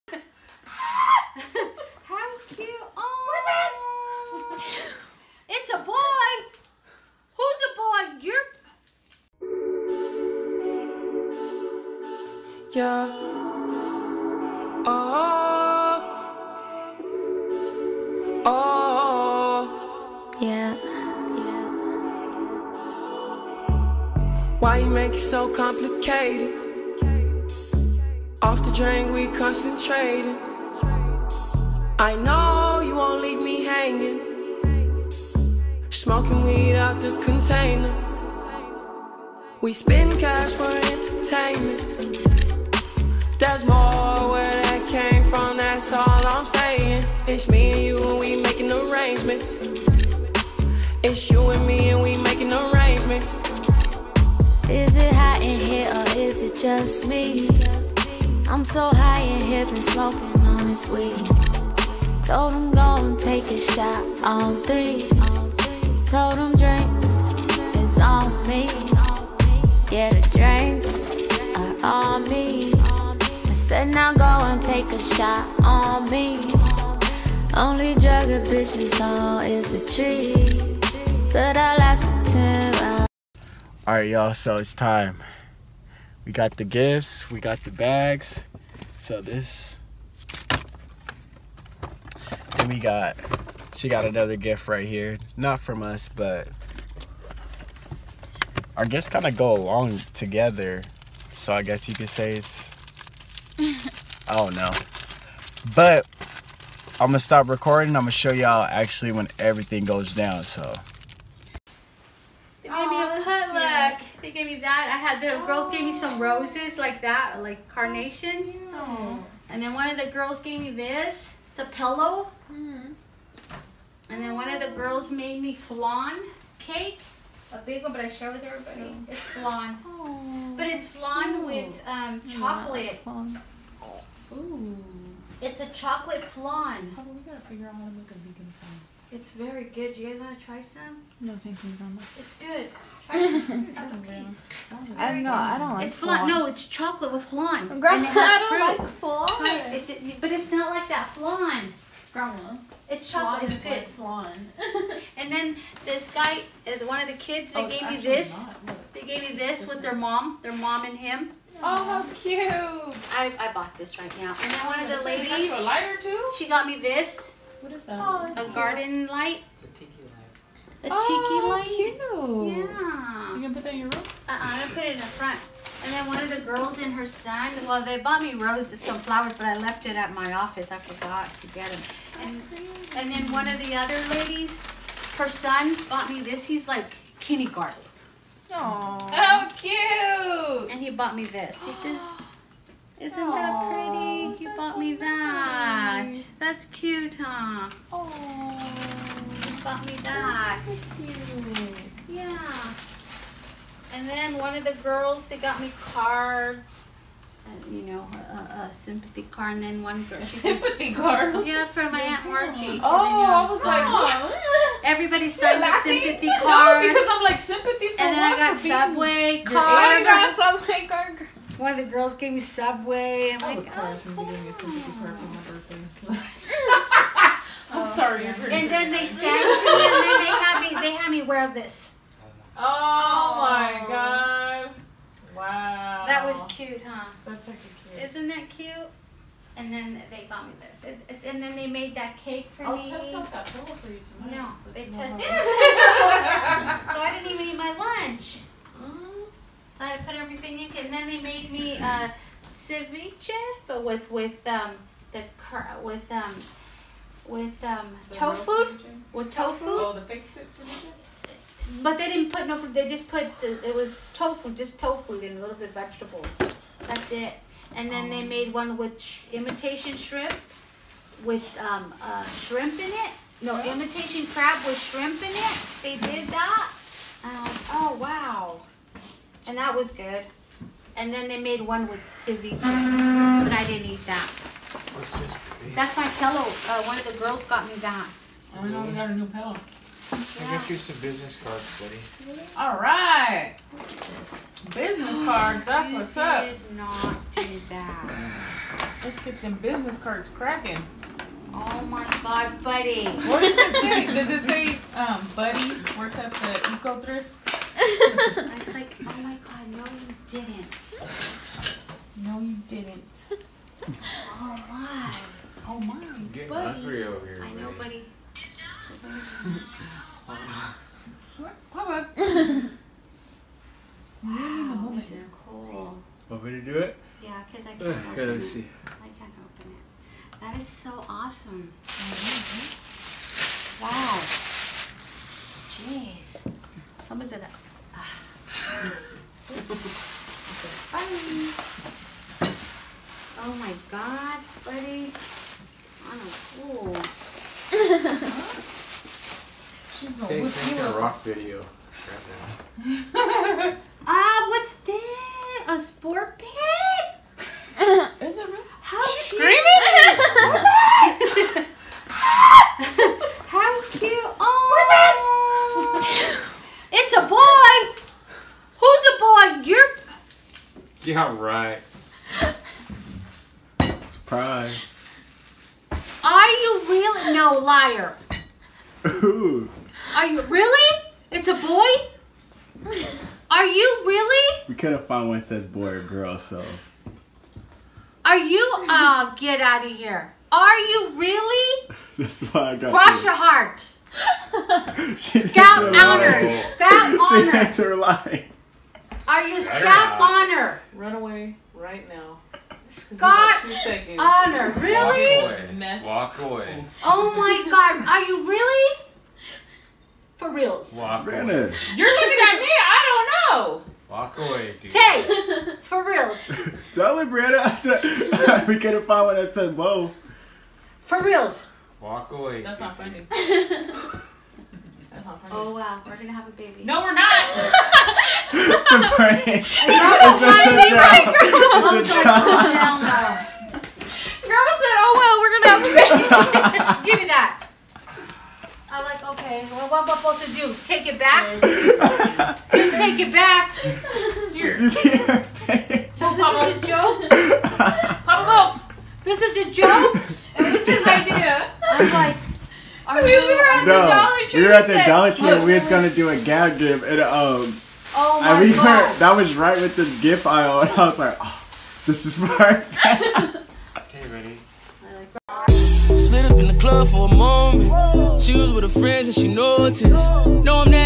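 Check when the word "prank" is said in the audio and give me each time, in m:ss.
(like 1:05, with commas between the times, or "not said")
7:09.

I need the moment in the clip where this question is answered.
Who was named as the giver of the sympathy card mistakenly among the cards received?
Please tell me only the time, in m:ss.
3:31.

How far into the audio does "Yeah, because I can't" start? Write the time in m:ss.
5:27.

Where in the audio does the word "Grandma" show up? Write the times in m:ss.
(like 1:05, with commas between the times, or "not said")
2:27, 2:32.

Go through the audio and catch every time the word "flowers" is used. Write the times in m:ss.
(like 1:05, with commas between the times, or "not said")
2:58.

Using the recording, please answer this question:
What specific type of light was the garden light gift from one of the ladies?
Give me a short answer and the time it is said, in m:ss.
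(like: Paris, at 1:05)
Tiki light, at 2:49.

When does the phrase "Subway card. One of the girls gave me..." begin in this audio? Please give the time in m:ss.
3:40.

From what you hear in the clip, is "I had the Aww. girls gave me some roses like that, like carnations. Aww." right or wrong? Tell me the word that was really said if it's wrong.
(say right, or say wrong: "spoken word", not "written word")
right.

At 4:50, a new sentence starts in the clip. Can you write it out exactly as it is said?
I got you some business cards, buddy.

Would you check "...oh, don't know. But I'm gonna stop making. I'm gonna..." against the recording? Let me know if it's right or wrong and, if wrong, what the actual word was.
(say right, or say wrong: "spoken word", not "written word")
wrong: "recording", not "making".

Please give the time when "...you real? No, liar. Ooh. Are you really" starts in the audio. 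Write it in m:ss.
6:16.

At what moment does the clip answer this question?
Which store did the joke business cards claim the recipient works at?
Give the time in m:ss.
5:05.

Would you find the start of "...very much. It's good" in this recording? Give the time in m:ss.
2:21.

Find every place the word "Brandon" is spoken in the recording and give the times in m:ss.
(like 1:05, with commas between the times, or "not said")
6:57.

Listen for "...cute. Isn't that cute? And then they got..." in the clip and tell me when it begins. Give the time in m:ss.
3:57.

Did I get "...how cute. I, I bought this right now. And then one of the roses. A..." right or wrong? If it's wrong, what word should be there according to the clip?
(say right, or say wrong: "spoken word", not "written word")
wrong: "ladies", not "roses".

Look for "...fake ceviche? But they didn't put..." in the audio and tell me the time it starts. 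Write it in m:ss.
4:20.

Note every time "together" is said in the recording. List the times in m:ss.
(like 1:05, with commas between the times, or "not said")
1:40.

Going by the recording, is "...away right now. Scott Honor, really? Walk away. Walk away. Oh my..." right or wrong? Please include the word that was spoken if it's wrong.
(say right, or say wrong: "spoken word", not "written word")
right.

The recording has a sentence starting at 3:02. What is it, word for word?
And, and then one of the other ladies, her son bought me this.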